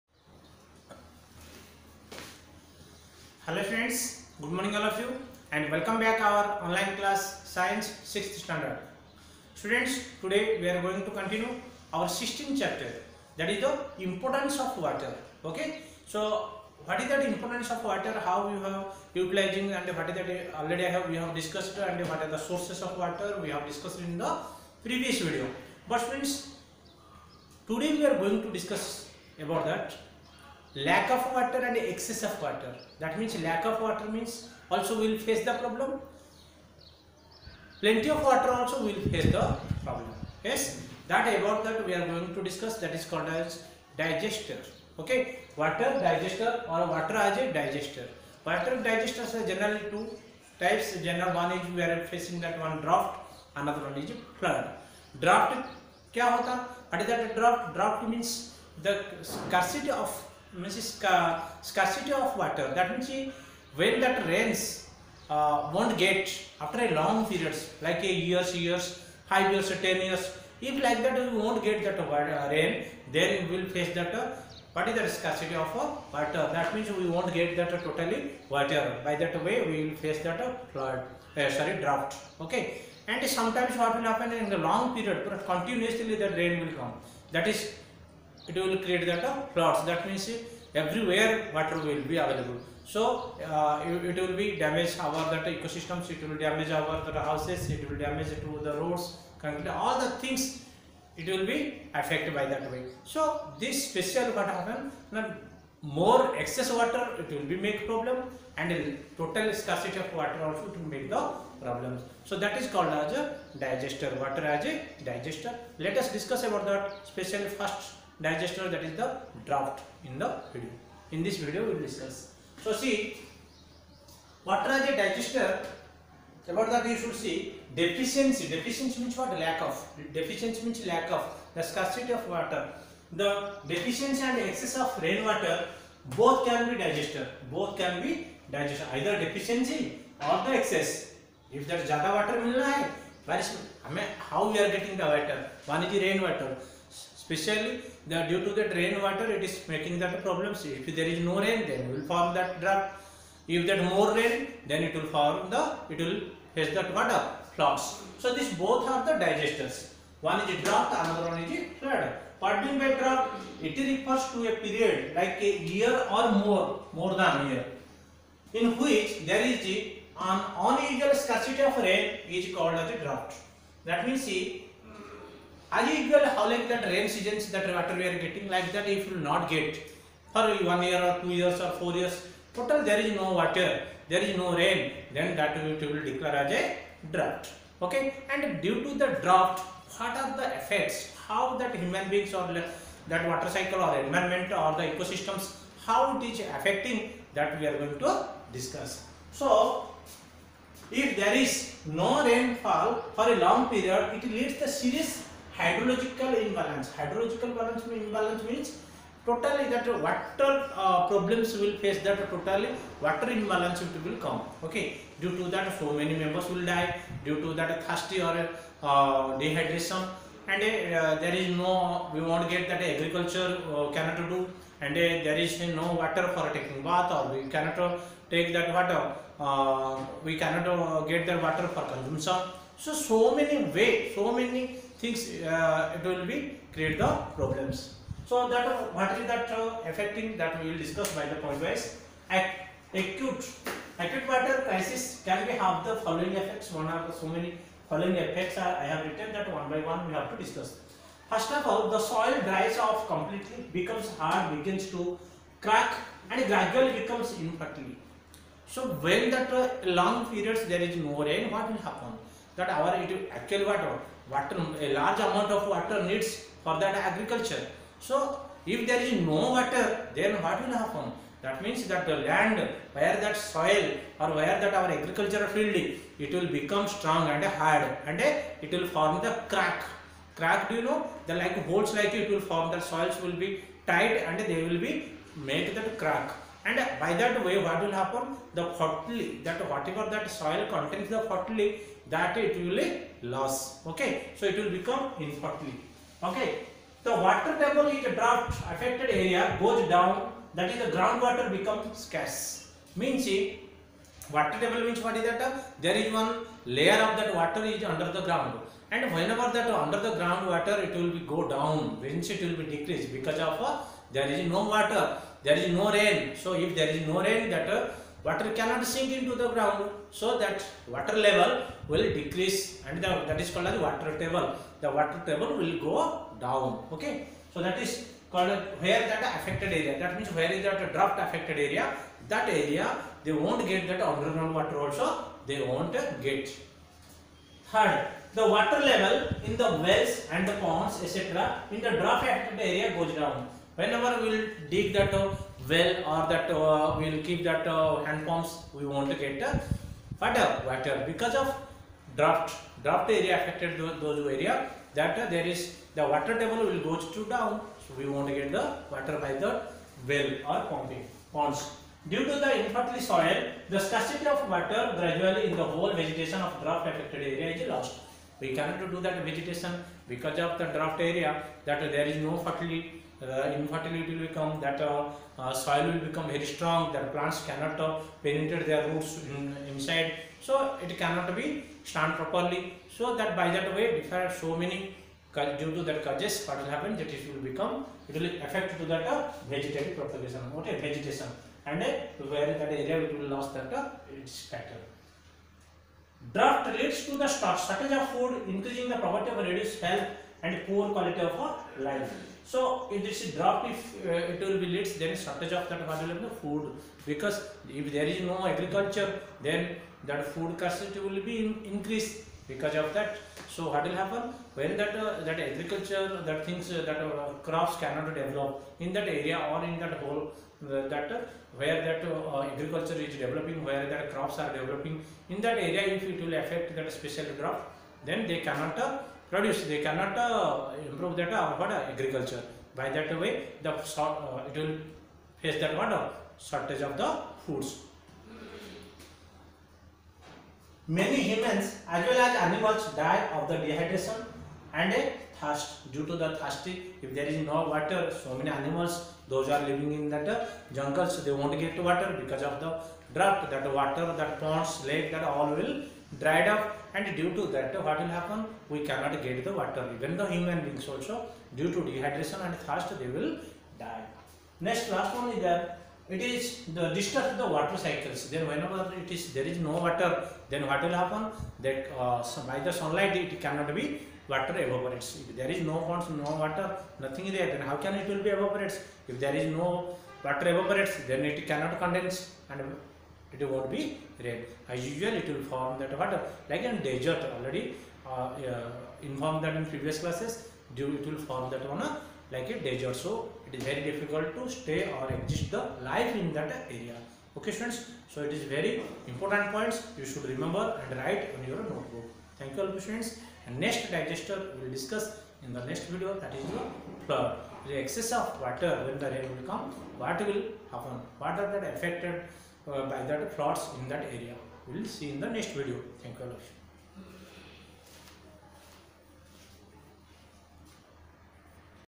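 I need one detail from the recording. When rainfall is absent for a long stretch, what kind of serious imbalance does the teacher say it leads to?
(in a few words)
hydrological imbalance.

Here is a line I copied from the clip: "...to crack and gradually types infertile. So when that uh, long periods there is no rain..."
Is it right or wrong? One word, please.
wrong.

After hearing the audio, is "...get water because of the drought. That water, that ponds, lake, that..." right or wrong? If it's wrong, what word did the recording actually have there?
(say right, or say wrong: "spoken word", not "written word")
right.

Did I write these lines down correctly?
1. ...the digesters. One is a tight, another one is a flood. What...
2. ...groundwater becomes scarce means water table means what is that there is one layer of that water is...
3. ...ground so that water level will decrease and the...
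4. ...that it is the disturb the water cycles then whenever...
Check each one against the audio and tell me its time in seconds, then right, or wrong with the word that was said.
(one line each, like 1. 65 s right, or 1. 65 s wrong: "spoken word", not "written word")
1. 159 s wrong: "drought", not "tight"
2. 300 s right
3. 319 s right
4. 465 s right.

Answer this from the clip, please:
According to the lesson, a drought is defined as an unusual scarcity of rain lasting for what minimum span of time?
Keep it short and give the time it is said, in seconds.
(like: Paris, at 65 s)
a year or more, at 165 s.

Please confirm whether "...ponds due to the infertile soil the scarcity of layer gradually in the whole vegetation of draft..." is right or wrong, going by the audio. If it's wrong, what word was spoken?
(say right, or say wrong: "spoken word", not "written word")
wrong: "water", not "layer".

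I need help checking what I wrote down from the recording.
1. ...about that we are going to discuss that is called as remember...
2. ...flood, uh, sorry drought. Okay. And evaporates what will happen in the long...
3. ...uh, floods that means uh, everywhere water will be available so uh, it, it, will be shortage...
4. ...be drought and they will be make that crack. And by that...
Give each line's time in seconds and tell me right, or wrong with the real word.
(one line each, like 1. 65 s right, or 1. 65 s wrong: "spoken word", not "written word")
1. 41 s wrong: "digester", not "remember"
2. 80 s wrong: "sometimes", not "evaporates"
3. 89 s wrong: "damage", not "shortage"
4. 283 s wrong: "tight", not "drought".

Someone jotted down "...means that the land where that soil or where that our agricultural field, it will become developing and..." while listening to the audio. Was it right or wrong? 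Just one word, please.
wrong.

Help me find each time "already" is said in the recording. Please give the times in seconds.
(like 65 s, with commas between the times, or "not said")
20 s, 487 s.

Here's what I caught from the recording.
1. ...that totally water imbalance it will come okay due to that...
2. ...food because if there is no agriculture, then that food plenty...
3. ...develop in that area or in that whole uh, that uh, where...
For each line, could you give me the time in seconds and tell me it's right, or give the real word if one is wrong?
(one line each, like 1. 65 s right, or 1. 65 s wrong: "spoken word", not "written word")
1. 212 s right
2. 406 s wrong: "scarcity", not "plenty"
3. 418 s right.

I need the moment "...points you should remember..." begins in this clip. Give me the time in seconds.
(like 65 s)
499 s.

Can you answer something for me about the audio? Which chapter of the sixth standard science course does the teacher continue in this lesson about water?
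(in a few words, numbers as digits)
16th.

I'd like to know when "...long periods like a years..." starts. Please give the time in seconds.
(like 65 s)
66 s.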